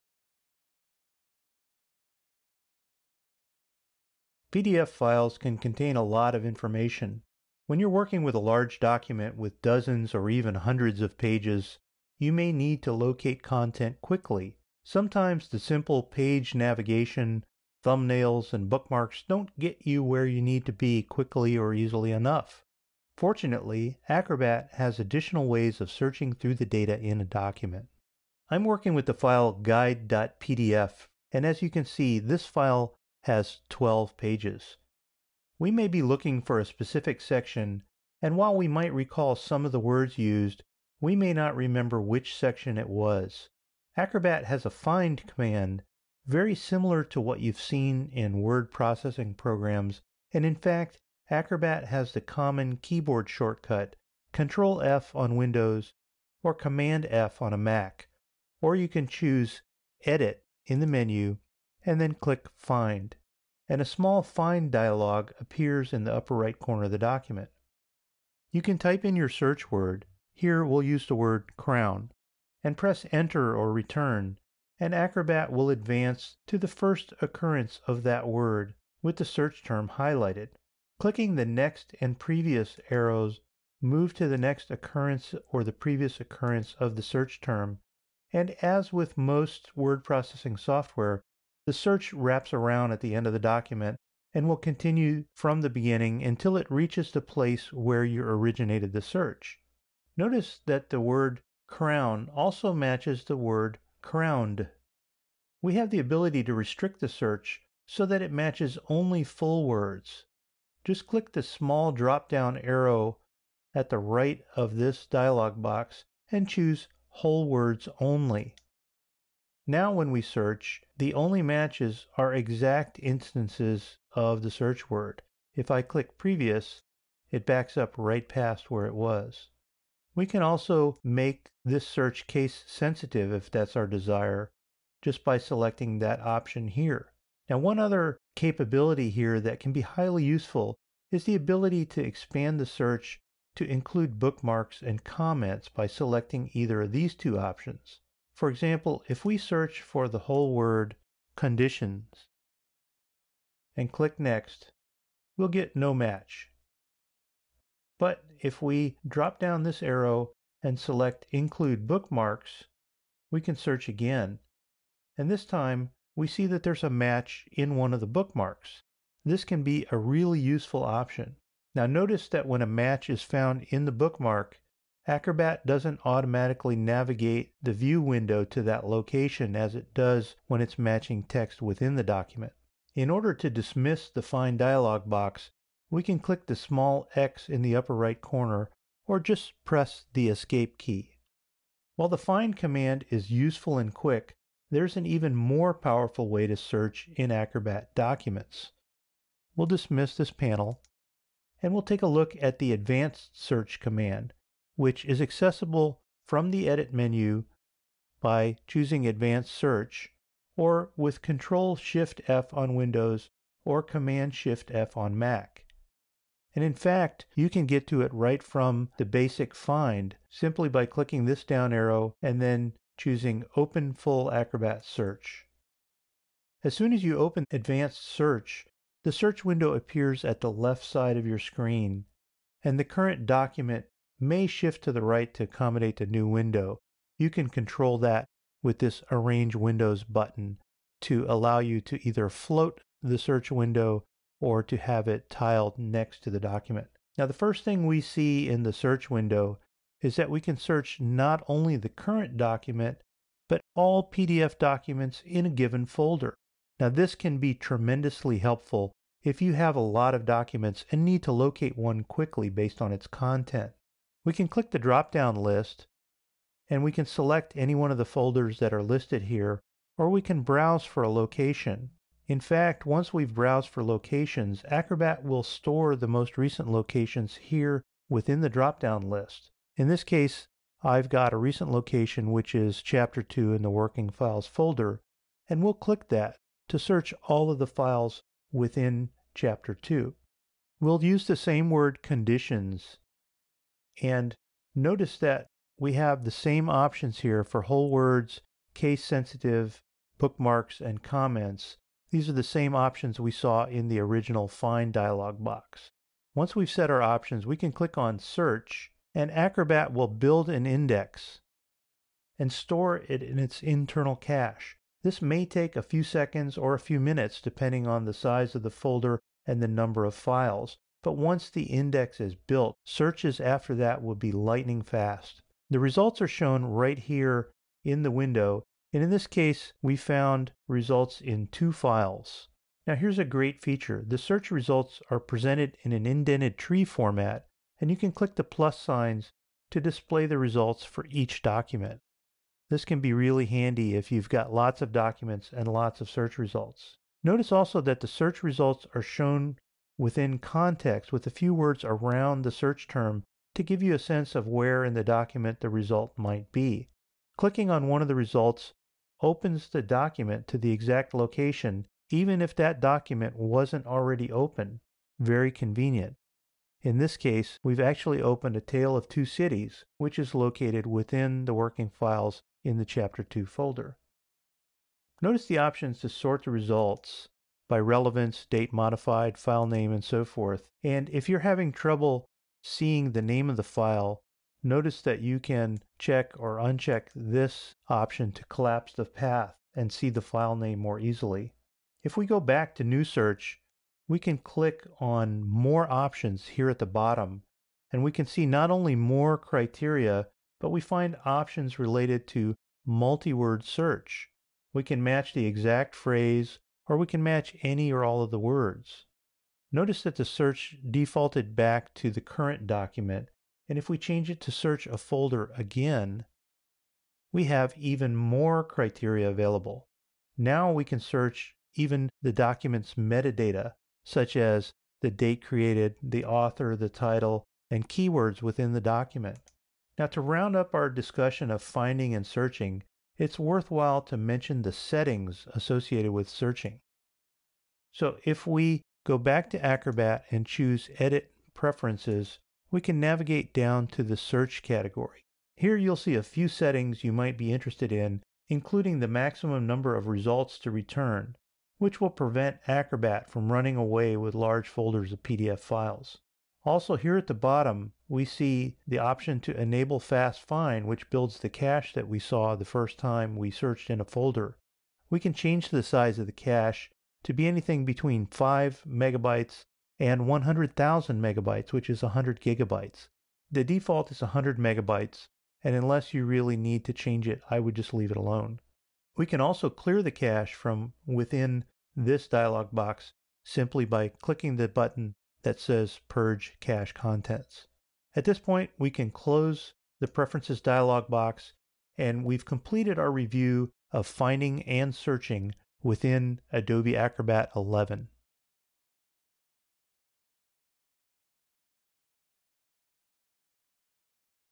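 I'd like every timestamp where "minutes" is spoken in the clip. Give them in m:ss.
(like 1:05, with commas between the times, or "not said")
5:16.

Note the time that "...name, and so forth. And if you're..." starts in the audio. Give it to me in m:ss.
6:19.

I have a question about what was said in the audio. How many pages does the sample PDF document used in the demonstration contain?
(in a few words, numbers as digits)
12.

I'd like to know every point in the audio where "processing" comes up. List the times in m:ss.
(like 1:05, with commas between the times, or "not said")
0:48, 1:30.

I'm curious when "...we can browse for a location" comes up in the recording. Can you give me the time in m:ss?
4:30.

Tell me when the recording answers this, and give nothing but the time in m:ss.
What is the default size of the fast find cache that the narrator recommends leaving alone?
7:54.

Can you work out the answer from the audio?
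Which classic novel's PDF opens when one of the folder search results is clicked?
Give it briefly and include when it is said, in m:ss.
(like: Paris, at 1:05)
A Tale of Two Cities, at 6:08.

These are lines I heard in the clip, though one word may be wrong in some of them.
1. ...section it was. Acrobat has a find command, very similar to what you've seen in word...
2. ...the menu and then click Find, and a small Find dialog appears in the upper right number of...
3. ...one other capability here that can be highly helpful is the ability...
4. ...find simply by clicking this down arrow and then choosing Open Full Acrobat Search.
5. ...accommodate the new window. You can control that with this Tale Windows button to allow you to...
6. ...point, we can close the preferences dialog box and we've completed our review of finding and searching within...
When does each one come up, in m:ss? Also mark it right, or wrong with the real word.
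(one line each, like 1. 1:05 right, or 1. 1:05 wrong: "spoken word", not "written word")
1. 0:42 right
2. 1:00 wrong: "corner", not "number"
3. 2:17 wrong: "useful", not "helpful"
4. 3:39 right
5. 3:55 wrong: "Arrange", not "Tale"
6. 8:08 right.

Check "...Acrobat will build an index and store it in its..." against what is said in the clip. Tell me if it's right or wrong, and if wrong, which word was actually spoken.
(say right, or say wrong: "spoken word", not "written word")
right.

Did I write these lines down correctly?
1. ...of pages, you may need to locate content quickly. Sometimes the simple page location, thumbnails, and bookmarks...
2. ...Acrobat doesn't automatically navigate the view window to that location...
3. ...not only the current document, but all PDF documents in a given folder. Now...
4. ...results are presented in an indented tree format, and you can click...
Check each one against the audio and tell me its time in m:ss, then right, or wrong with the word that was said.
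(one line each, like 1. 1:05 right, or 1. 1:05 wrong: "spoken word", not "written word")
1. 0:10 wrong: "navigation", not "location"
2. 2:55 right
3. 4:11 right
4. 5:34 right.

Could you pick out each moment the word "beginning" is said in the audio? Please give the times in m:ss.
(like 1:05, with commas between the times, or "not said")
1:35.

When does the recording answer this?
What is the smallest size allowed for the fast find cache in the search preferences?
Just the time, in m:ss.
7:48.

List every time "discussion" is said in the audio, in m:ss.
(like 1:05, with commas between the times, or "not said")
7:10.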